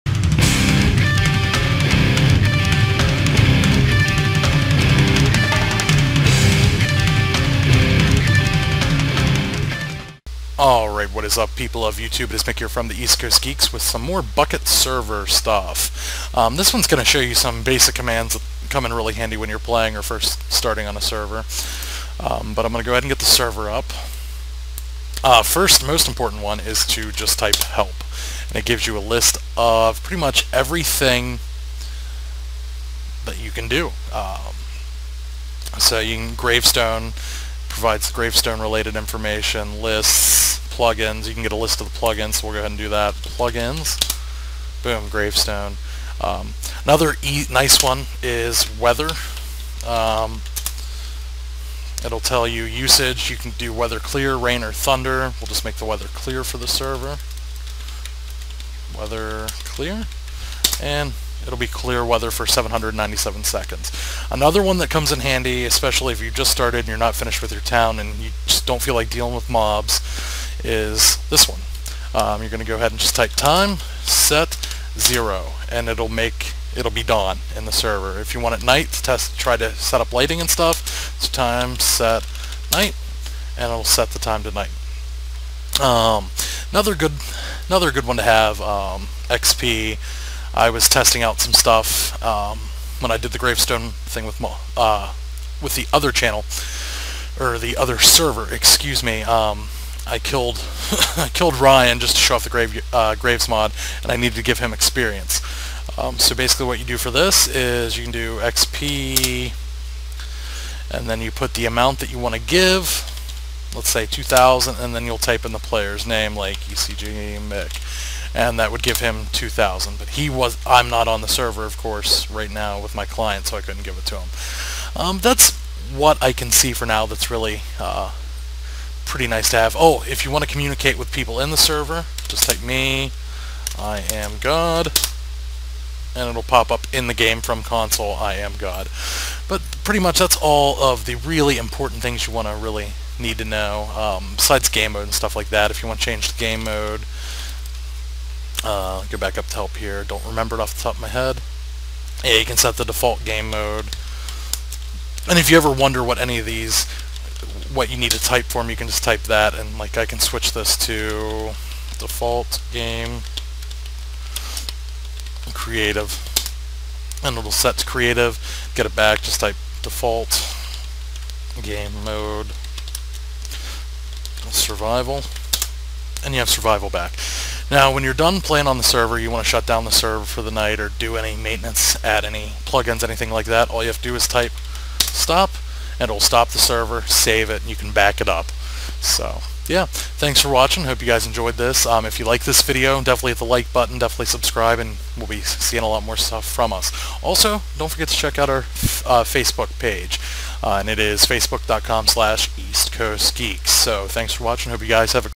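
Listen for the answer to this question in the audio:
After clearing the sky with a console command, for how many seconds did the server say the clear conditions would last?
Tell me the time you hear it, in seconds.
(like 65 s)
62 s.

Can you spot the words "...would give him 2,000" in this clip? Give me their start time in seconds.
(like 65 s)
118 s.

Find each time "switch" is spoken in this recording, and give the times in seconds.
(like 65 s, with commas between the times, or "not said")
160 s.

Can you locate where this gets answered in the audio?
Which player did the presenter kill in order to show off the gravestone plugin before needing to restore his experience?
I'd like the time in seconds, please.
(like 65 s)
101 s.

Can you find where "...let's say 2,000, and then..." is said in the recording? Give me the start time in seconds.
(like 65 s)
113 s.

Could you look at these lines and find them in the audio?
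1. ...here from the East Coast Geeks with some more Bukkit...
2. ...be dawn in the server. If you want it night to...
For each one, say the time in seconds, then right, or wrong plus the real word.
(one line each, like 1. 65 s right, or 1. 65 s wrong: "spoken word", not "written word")
1. 12 s right
2. 76 s right.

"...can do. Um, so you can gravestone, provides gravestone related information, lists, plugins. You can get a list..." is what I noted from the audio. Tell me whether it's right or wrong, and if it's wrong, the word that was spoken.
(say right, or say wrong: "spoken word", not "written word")
right.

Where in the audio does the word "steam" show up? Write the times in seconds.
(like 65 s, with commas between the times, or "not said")
not said.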